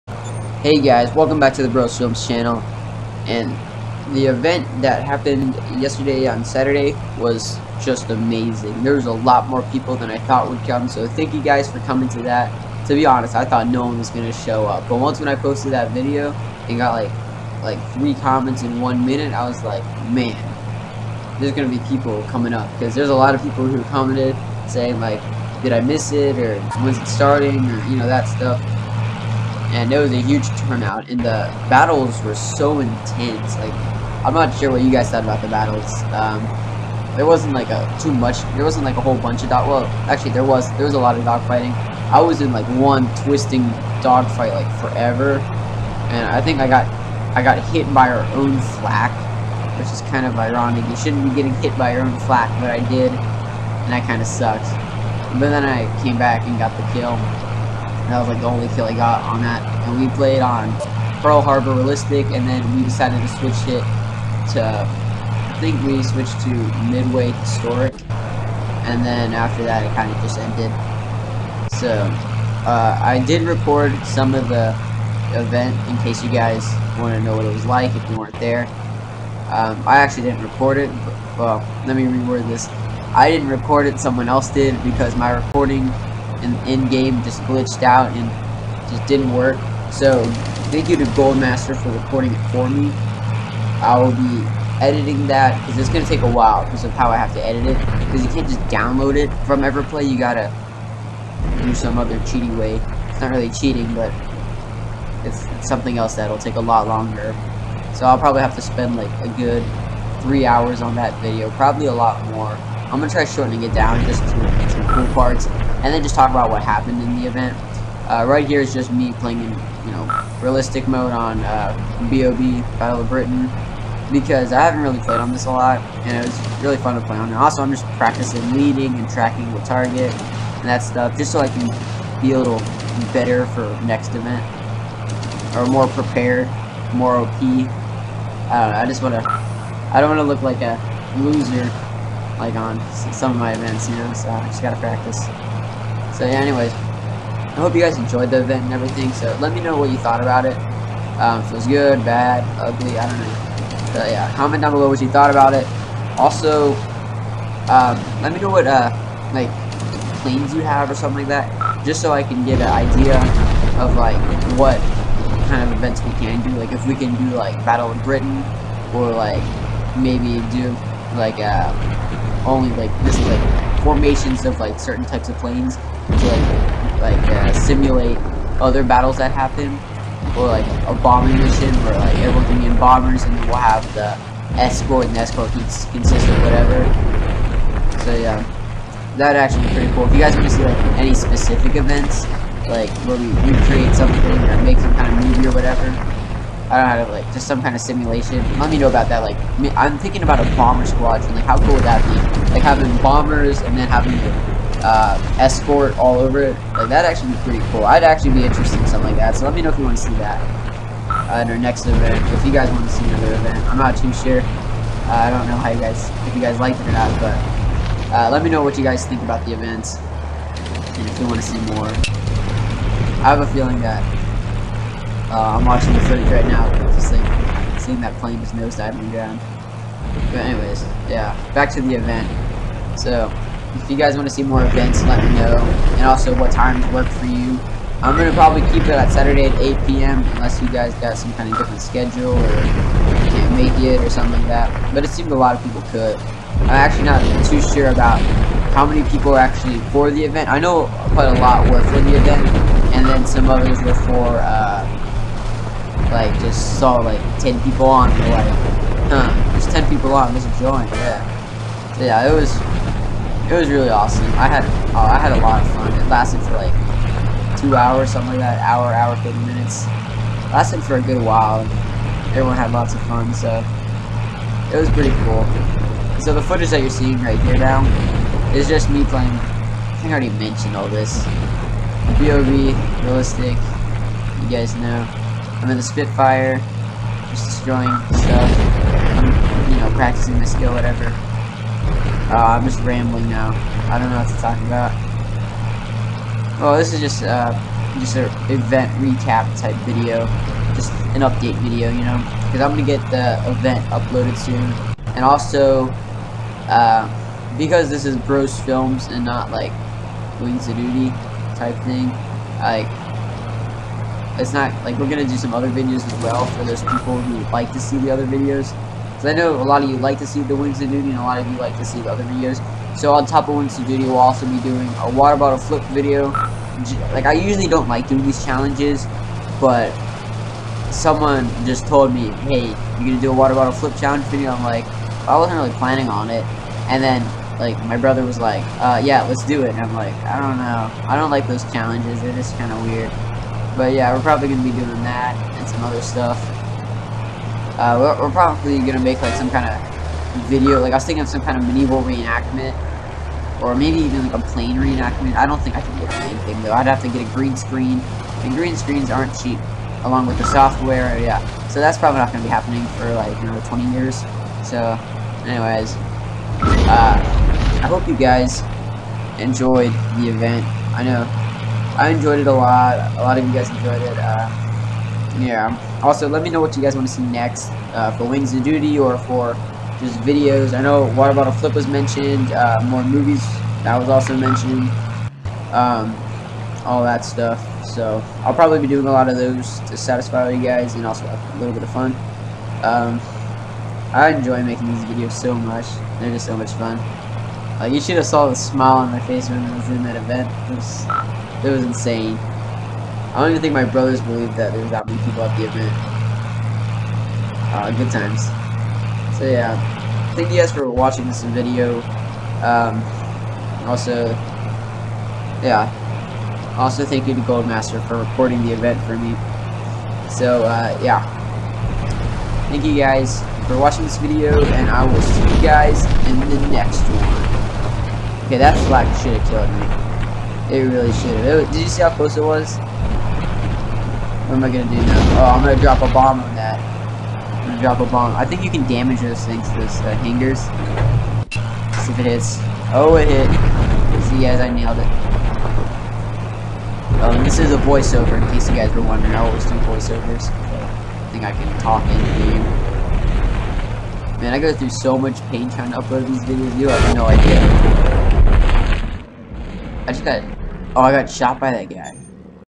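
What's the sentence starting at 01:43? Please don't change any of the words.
It's not really cheating, but it's, it's something else that'll take a lot longer.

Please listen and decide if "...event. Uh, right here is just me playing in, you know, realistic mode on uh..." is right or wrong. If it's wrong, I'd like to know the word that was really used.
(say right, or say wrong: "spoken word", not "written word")
right.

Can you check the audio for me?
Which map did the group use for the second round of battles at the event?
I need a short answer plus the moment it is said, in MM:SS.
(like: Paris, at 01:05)
Midway Historic, at 01:06.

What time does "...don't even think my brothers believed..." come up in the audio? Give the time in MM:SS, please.
06:43.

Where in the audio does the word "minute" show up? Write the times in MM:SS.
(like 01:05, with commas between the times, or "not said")
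00:19, 04:29.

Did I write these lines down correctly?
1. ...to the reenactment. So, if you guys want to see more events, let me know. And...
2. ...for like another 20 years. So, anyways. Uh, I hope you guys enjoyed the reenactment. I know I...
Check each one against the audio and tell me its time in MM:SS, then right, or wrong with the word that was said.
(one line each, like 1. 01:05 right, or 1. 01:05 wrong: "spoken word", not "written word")
1. 03:51 wrong: "event", not "reenactment"
2. 06:02 wrong: "event", not "reenactment".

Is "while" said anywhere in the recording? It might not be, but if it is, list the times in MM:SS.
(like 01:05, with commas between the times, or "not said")
01:36, 04:31.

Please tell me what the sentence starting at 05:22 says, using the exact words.
So on top of Wings of Duty, we'll also be doing a water bottle flip video.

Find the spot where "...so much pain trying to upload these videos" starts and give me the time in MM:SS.
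07:34.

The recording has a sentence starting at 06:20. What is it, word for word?
I know Water Bottle Flip was mentioned.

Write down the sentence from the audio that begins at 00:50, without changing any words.
You shouldn't be getting hit by your own flak, but I did, and that kind of sucks.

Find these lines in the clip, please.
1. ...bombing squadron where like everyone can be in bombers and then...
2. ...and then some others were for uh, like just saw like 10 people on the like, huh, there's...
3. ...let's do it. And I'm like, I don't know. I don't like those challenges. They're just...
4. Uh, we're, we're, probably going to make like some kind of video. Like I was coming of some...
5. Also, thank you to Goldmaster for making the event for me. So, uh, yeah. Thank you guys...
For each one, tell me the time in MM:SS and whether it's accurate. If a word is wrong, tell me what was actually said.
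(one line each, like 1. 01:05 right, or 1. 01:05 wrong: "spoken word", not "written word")
1. 03:01 wrong: "mission", not "squadron"
2. 04:12 right
3. 05:39 right
4. 05:47 wrong: "thinking", not "coming"
5. 06:56 wrong: "recording", not "making".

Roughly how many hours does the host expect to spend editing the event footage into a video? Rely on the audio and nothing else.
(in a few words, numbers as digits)
3.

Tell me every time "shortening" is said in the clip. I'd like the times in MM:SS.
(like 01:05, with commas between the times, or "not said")
01:53.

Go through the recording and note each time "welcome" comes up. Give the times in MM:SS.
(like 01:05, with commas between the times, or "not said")
00:01.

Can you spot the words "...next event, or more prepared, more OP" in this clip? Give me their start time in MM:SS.
02:13.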